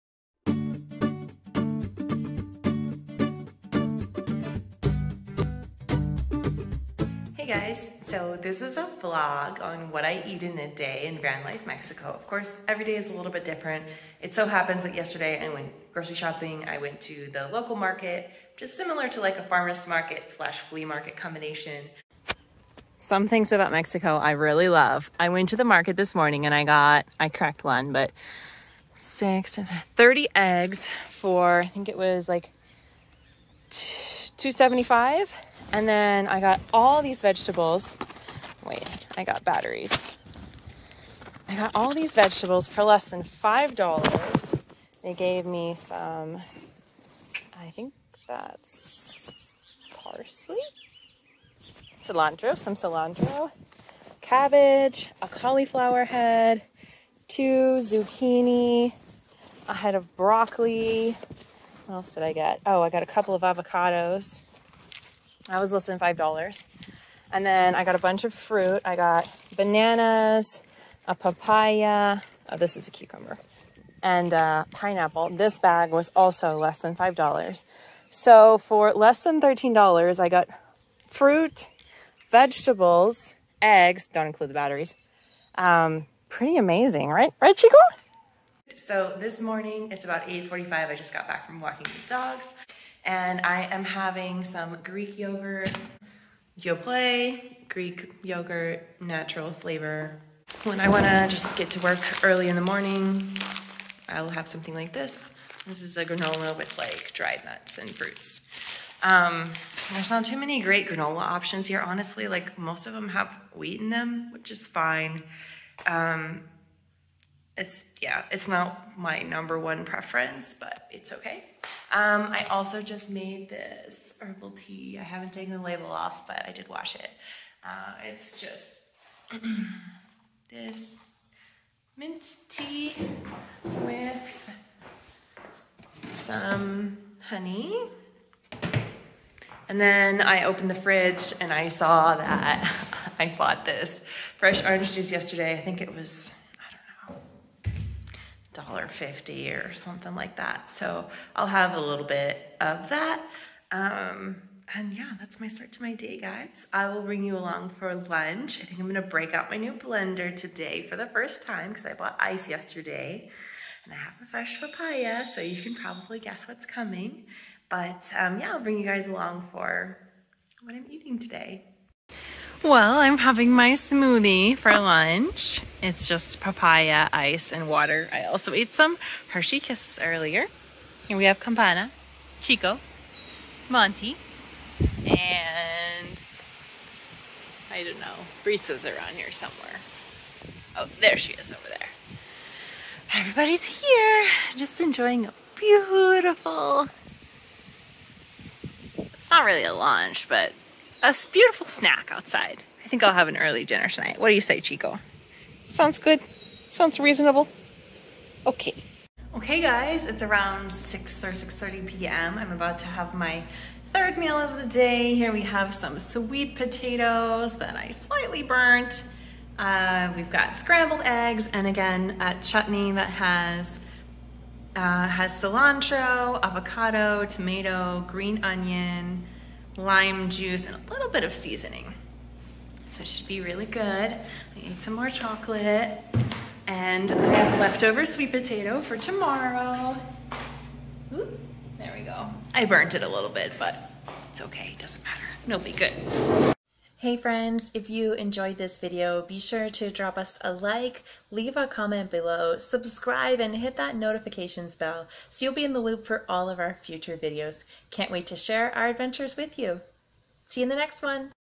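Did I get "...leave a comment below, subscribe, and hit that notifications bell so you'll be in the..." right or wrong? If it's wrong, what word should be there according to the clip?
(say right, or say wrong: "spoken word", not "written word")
right.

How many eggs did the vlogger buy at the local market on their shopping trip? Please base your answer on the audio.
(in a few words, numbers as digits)
30.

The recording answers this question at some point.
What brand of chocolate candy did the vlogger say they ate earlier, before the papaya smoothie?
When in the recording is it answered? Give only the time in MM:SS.
02:59.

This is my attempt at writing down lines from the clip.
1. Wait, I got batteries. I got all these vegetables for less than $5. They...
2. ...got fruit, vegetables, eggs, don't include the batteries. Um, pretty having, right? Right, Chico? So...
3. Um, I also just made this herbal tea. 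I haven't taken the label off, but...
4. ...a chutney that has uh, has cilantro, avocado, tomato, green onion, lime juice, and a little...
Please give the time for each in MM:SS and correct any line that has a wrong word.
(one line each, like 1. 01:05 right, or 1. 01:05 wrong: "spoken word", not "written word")
1. 00:38 right
2. 01:20 wrong: "amazing", not "having"
3. 02:01 right
4. 03:42 right.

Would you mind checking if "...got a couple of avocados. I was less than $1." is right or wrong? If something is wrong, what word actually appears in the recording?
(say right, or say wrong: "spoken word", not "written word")
wrong: "5", not "1".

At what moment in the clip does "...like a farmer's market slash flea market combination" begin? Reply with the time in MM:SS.
00:19.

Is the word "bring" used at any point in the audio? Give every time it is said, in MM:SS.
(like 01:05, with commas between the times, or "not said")
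02:37, 02:48.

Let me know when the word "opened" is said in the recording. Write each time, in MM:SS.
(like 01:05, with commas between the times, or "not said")
02:20.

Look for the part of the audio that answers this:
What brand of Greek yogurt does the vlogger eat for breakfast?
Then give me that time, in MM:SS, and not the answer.
01:36.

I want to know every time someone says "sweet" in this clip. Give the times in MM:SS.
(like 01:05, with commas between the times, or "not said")
03:35, 03:58.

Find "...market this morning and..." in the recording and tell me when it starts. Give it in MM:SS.
00:25.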